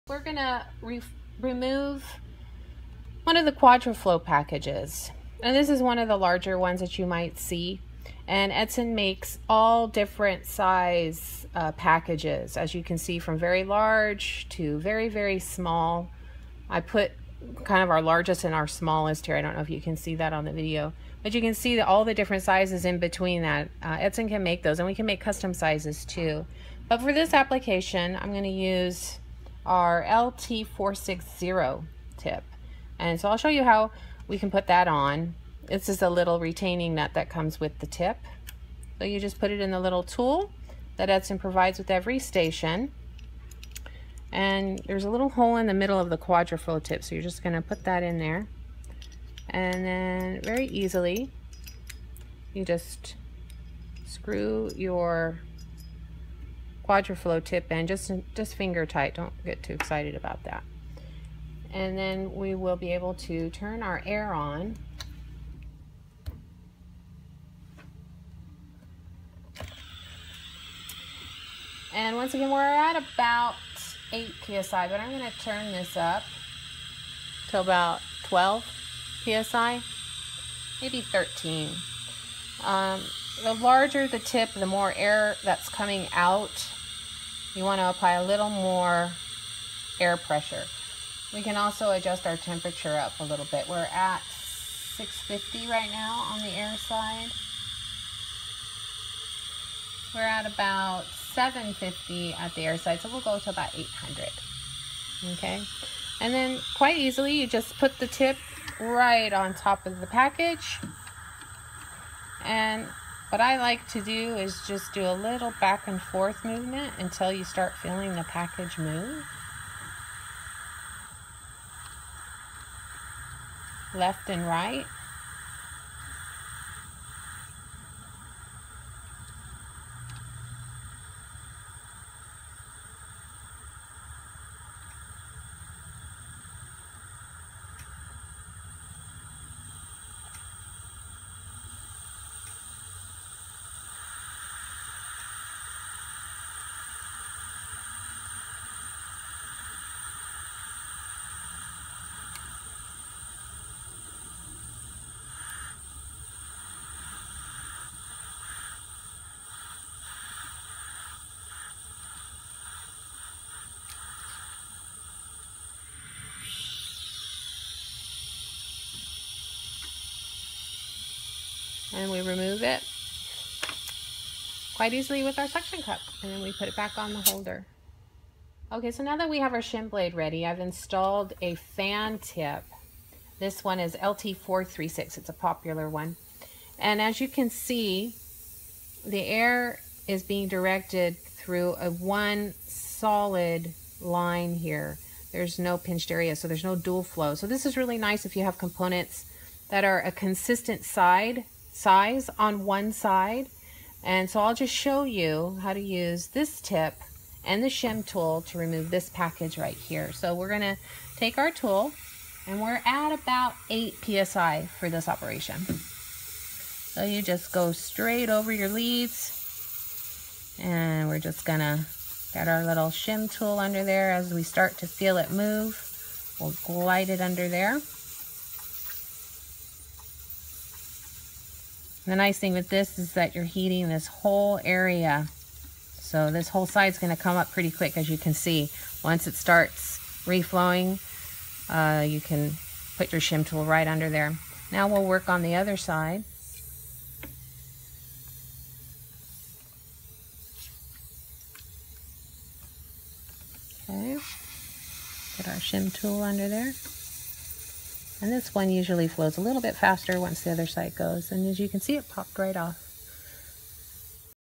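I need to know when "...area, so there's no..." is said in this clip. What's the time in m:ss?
3:16.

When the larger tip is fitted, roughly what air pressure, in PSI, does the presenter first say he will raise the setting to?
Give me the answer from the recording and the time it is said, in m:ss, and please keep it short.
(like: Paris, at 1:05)
12 PSI, at 1:18.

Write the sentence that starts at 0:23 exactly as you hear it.
Uh, can make those, and we can make custom sizes too.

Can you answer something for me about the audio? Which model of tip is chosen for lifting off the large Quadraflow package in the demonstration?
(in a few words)
LT460.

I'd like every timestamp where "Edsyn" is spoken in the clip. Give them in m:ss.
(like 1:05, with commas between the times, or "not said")
0:08, 0:41.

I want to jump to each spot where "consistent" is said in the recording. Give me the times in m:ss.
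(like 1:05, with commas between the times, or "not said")
3:20.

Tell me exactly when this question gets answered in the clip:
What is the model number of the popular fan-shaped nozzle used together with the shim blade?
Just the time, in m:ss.
3:03.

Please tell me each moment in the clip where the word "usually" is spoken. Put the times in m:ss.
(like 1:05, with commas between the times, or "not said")
4:18.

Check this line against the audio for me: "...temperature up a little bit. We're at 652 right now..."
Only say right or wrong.
wrong.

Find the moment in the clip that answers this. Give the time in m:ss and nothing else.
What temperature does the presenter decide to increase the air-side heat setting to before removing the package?
1:43.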